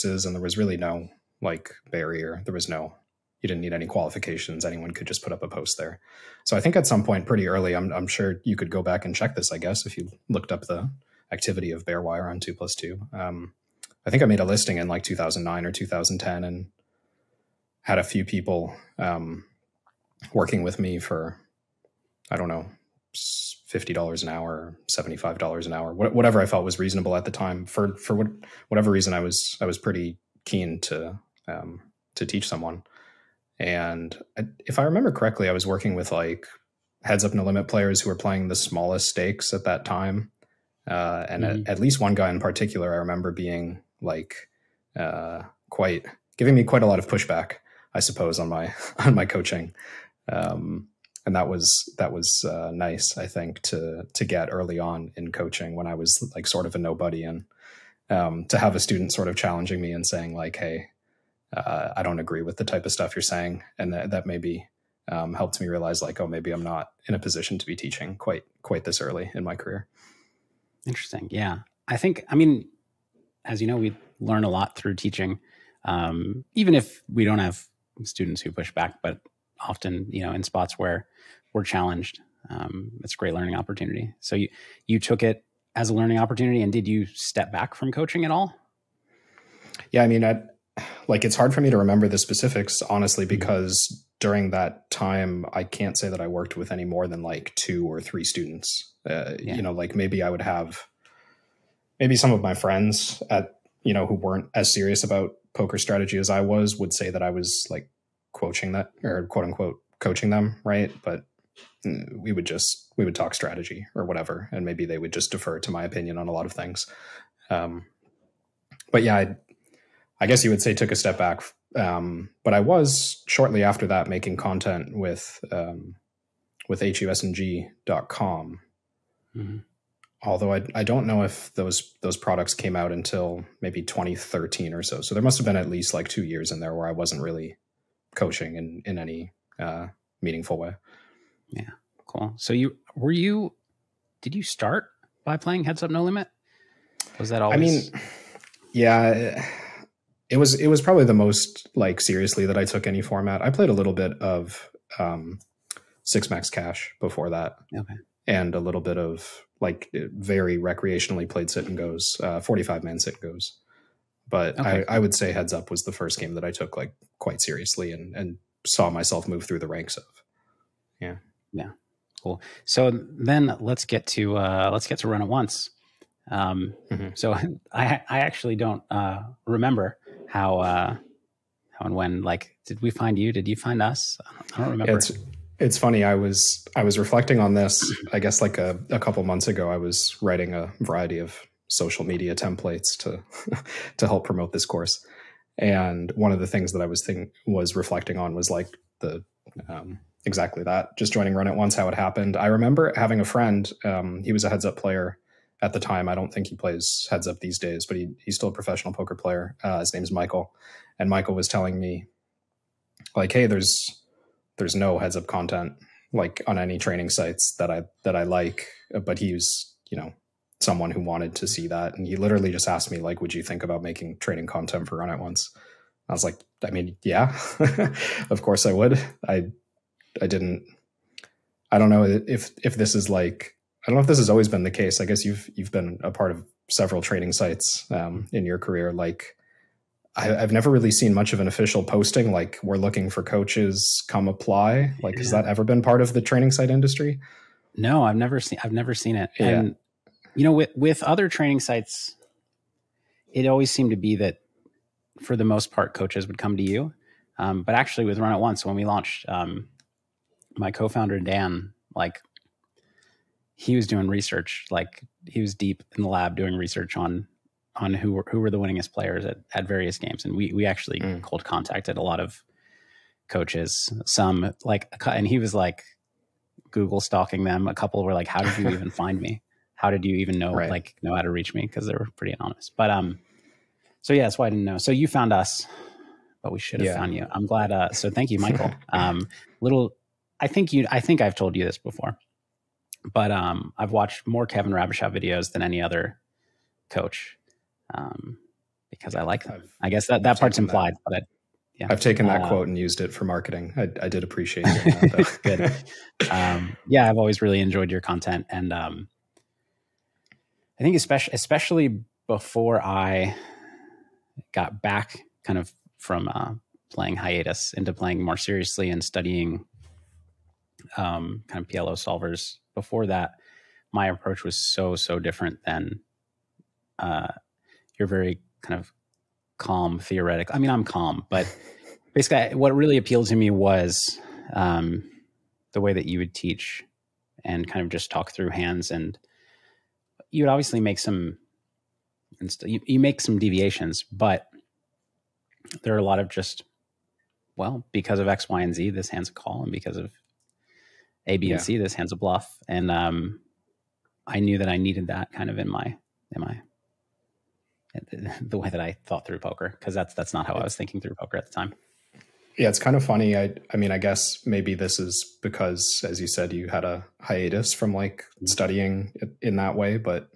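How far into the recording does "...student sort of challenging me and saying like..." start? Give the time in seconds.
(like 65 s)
58 s.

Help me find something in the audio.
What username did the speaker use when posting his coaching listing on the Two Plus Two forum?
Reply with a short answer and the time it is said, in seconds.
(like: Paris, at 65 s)
Bearwire, at 11 s.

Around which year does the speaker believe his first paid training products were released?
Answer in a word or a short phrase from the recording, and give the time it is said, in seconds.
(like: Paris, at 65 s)
2013, at 133 s.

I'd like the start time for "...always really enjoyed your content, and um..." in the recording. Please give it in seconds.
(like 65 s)
307 s.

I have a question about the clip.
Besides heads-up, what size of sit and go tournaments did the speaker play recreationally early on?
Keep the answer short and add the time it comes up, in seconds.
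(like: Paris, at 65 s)
45-man, at 162 s.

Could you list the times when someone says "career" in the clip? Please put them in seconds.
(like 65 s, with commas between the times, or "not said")
69 s, 238 s.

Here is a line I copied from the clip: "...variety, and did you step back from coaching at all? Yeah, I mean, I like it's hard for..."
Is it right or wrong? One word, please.
wrong.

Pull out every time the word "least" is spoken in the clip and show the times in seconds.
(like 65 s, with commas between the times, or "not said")
41 s, 135 s.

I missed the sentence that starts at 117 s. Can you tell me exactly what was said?
Um, but yeah, I, I, guess you would say took a step back.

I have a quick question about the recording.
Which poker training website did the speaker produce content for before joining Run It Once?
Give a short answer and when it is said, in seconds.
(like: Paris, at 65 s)
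husng.com, at 126 s.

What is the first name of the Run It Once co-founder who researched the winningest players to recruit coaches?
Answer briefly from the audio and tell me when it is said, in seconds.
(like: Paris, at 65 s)
Dan, at 261 s.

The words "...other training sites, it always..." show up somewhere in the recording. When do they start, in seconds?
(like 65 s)
251 s.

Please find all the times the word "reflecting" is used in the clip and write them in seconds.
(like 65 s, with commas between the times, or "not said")
186 s, 197 s.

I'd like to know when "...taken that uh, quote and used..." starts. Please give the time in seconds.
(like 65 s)
301 s.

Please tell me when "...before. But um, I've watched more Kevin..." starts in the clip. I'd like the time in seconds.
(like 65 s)
291 s.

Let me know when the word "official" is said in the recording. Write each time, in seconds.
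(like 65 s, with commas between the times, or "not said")
241 s.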